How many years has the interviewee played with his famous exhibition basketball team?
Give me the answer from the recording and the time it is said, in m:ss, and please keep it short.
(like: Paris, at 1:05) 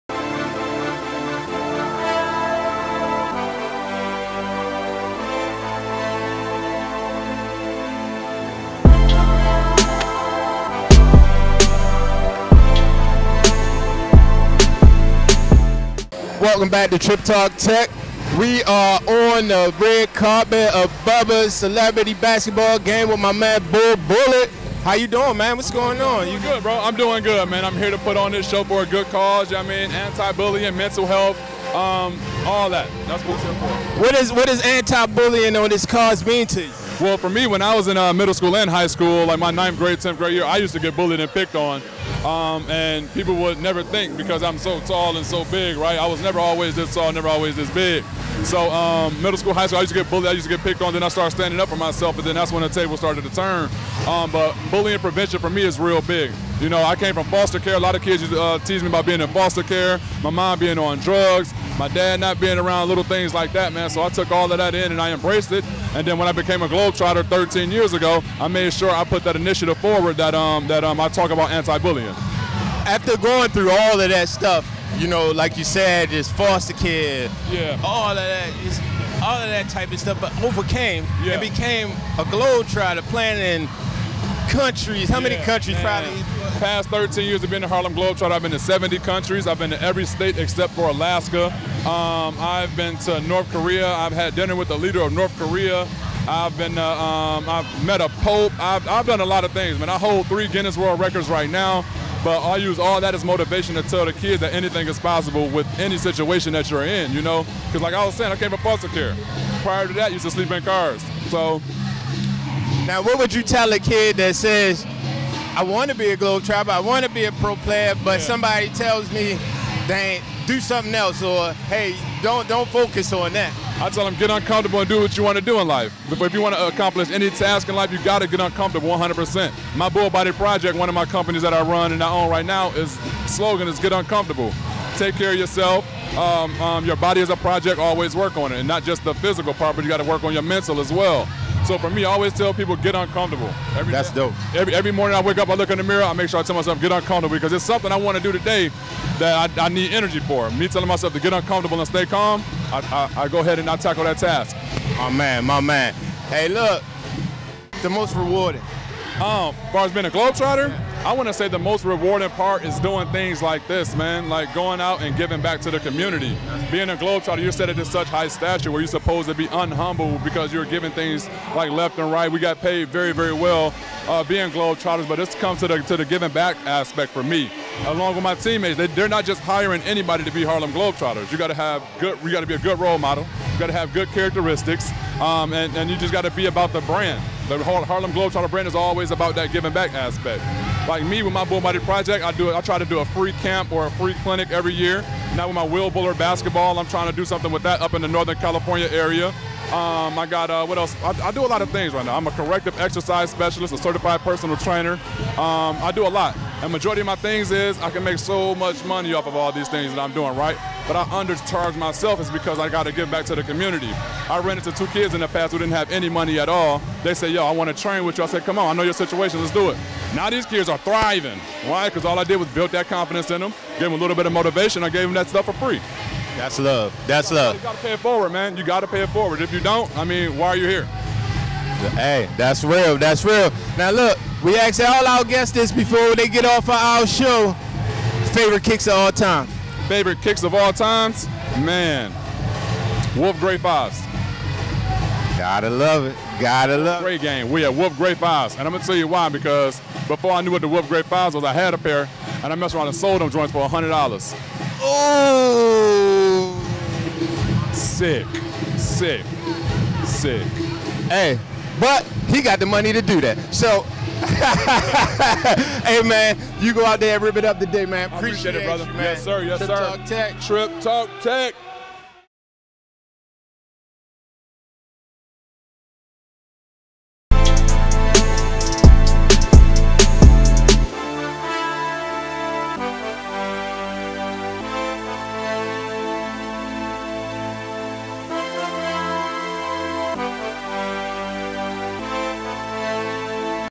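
13, at 1:26.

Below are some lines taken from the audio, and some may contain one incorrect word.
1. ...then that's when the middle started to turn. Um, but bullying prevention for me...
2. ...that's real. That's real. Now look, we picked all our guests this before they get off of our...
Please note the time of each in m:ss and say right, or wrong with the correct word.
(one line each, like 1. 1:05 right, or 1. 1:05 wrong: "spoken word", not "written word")
1. 0:52 wrong: "table", not "middle"
2. 3:52 wrong: "asked", not "picked".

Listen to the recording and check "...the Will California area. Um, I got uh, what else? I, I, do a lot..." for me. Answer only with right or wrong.
wrong.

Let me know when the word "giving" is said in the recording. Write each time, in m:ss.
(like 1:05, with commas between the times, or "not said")
2:45, 2:50, 2:56, 3:09.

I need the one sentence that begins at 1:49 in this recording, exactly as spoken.
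Prior to that, I used to sleep in cars.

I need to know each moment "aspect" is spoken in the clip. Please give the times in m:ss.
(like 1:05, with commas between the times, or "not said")
2:56, 3:09.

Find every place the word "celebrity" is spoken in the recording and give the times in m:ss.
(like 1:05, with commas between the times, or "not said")
0:21.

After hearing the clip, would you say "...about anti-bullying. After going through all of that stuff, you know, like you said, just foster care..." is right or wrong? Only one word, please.
right.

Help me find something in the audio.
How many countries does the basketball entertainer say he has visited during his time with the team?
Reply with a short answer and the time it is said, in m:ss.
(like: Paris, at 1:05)
70, at 1:28.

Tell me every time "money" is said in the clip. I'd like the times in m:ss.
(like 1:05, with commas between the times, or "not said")
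3:28, 3:36, 4:22.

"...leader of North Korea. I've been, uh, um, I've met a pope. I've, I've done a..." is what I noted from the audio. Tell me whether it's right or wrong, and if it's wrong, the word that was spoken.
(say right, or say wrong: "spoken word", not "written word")
right.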